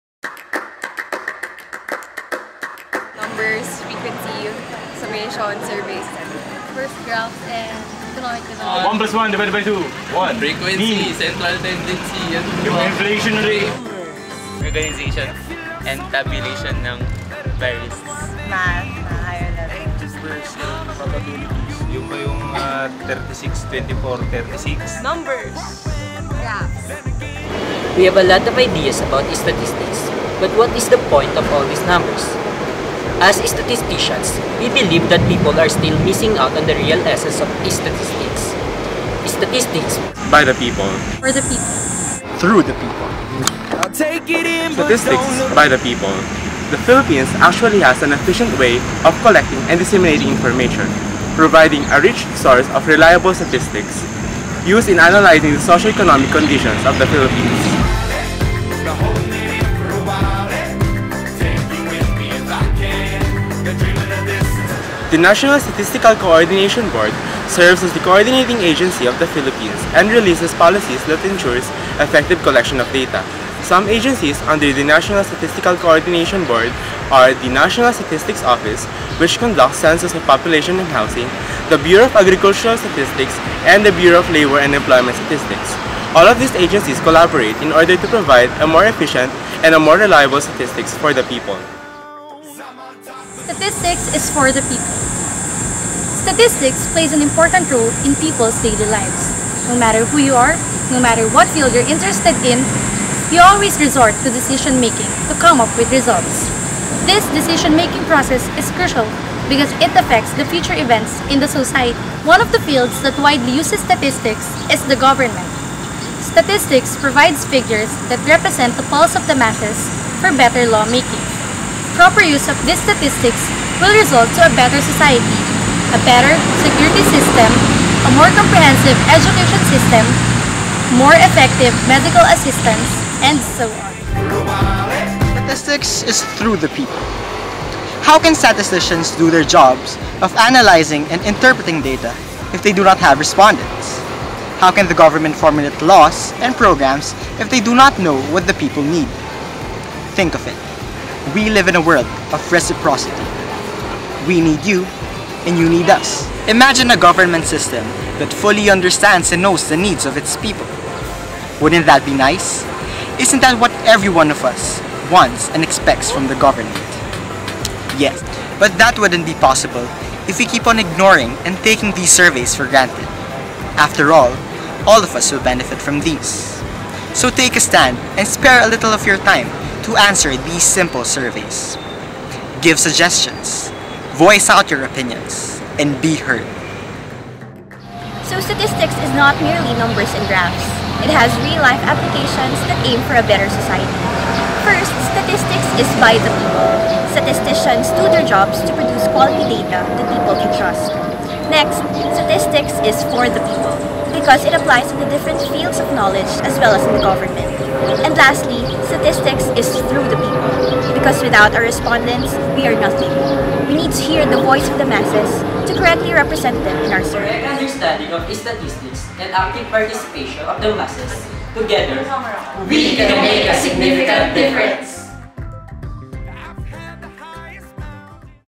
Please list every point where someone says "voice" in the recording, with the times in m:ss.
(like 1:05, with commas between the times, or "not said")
3:04, 3:34.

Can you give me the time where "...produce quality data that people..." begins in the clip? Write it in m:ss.
3:18.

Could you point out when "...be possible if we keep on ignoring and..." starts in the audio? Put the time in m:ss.
2:49.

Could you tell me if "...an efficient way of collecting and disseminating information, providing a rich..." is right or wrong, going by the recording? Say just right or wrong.
right.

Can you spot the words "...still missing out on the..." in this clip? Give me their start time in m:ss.
0:35.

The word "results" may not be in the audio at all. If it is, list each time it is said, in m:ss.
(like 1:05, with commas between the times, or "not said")
1:45, 2:03.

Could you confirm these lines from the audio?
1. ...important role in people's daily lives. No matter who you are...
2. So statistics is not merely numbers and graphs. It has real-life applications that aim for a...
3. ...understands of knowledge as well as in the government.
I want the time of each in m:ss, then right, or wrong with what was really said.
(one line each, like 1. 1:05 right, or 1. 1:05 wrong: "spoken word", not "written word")
1. 1:37 right
2. 3:08 right
3. 3:25 wrong: "fields", not "understands".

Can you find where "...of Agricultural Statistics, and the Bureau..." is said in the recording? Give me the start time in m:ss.
1:22.